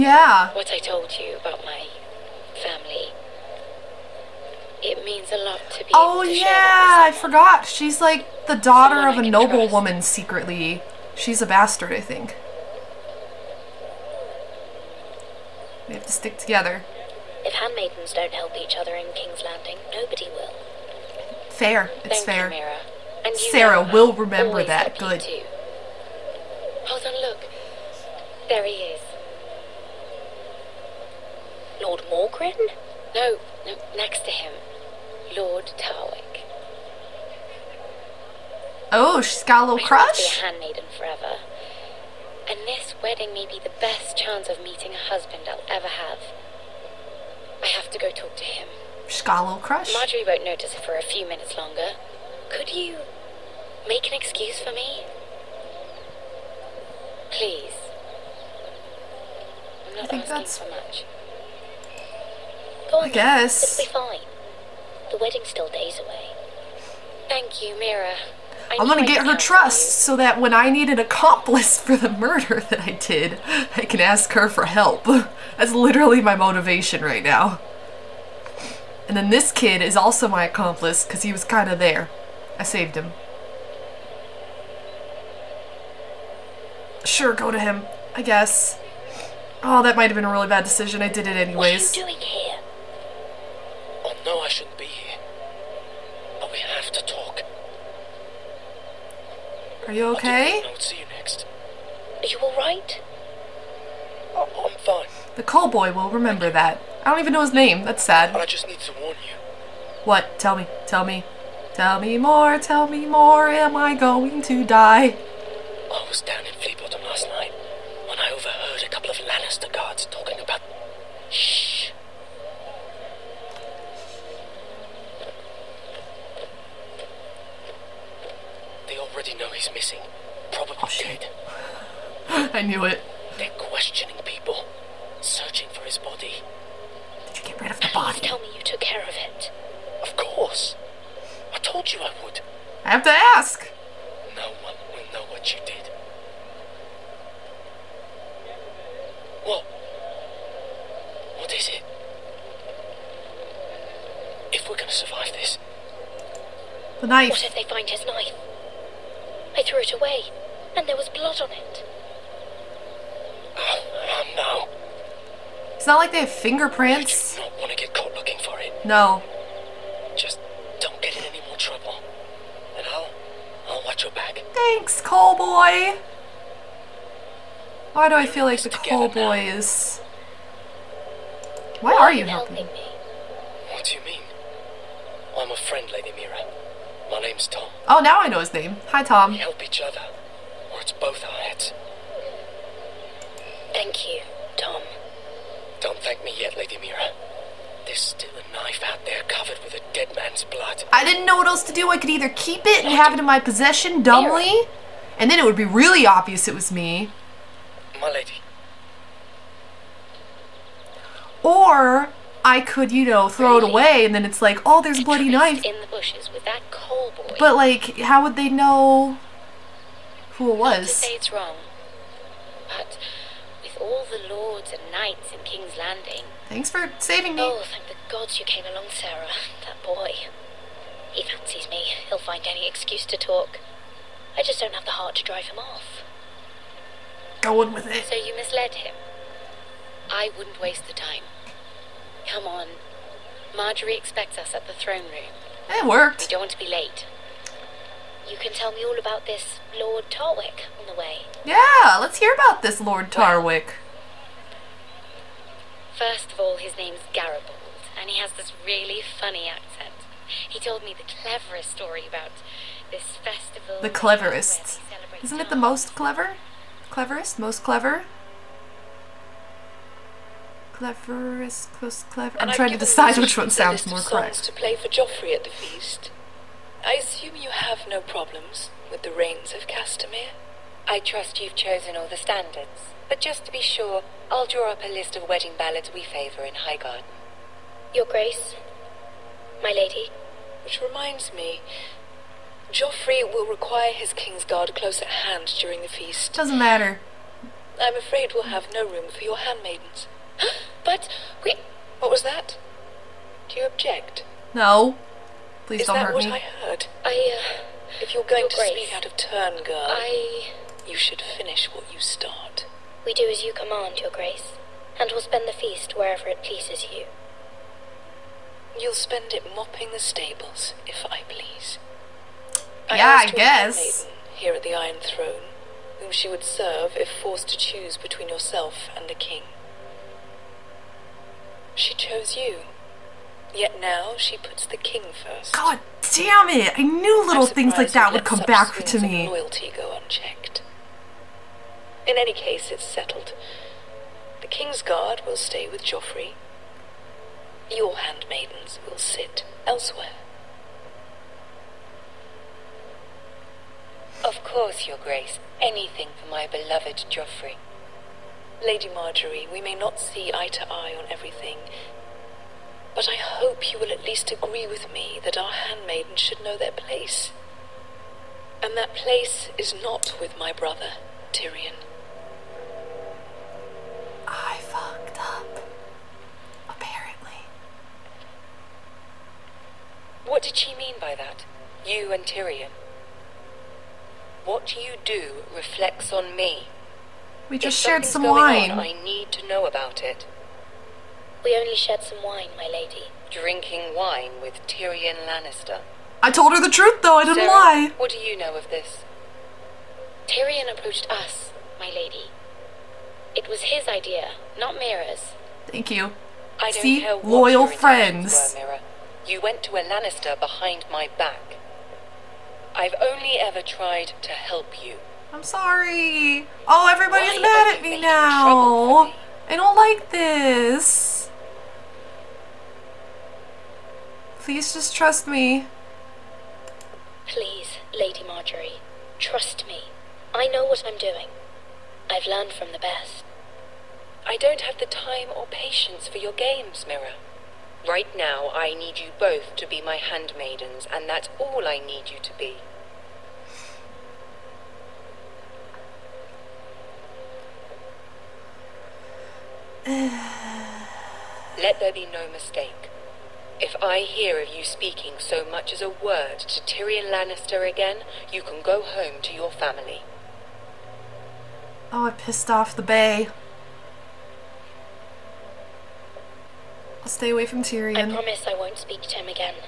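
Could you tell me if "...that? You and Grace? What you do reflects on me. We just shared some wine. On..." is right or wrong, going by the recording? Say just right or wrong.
wrong.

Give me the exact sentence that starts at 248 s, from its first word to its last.
You can tell me all about this Lord Tarwick on the way.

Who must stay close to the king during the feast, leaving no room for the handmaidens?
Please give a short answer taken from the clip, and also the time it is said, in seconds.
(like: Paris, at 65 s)
His Kingsguard, at 294 s.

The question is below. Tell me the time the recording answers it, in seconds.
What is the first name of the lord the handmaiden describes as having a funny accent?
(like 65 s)
257 s.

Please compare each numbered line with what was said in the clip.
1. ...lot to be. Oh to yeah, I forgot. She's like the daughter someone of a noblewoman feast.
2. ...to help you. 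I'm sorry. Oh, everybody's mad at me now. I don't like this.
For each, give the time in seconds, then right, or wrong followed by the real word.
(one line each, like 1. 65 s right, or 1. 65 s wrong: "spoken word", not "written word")
1. 5 s wrong: "trust", not "feast"
2. 414 s right.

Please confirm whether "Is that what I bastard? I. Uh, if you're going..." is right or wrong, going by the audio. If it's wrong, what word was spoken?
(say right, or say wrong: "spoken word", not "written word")
wrong: "heard", not "bastard".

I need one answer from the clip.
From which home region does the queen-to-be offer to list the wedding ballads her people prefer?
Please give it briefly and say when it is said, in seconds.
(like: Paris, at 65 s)
Highgarden, at 286 s.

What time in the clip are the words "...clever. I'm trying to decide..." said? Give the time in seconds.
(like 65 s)
272 s.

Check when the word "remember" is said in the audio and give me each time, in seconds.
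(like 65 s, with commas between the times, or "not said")
24 s, 106 s.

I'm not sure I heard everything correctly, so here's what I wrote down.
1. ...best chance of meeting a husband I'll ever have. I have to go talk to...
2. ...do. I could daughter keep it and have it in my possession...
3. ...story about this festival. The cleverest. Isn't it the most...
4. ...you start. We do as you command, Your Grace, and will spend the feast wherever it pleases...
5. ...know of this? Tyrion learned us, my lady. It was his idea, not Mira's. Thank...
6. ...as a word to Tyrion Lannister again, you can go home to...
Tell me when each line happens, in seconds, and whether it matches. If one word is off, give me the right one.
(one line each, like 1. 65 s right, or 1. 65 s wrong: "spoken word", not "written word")
1. 43 s right
2. 201 s wrong: "either", not "daughter"
3. 261 s right
4. 311 s right
5. 398 s wrong: "approached", not "learned"
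6. 455 s right.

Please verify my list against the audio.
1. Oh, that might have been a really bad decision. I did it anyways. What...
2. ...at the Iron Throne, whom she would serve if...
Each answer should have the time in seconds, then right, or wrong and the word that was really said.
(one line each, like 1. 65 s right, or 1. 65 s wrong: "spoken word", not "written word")
1. 89 s right
2. 324 s right.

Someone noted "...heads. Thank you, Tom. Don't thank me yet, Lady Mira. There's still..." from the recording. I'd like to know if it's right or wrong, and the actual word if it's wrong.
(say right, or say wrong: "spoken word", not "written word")
right.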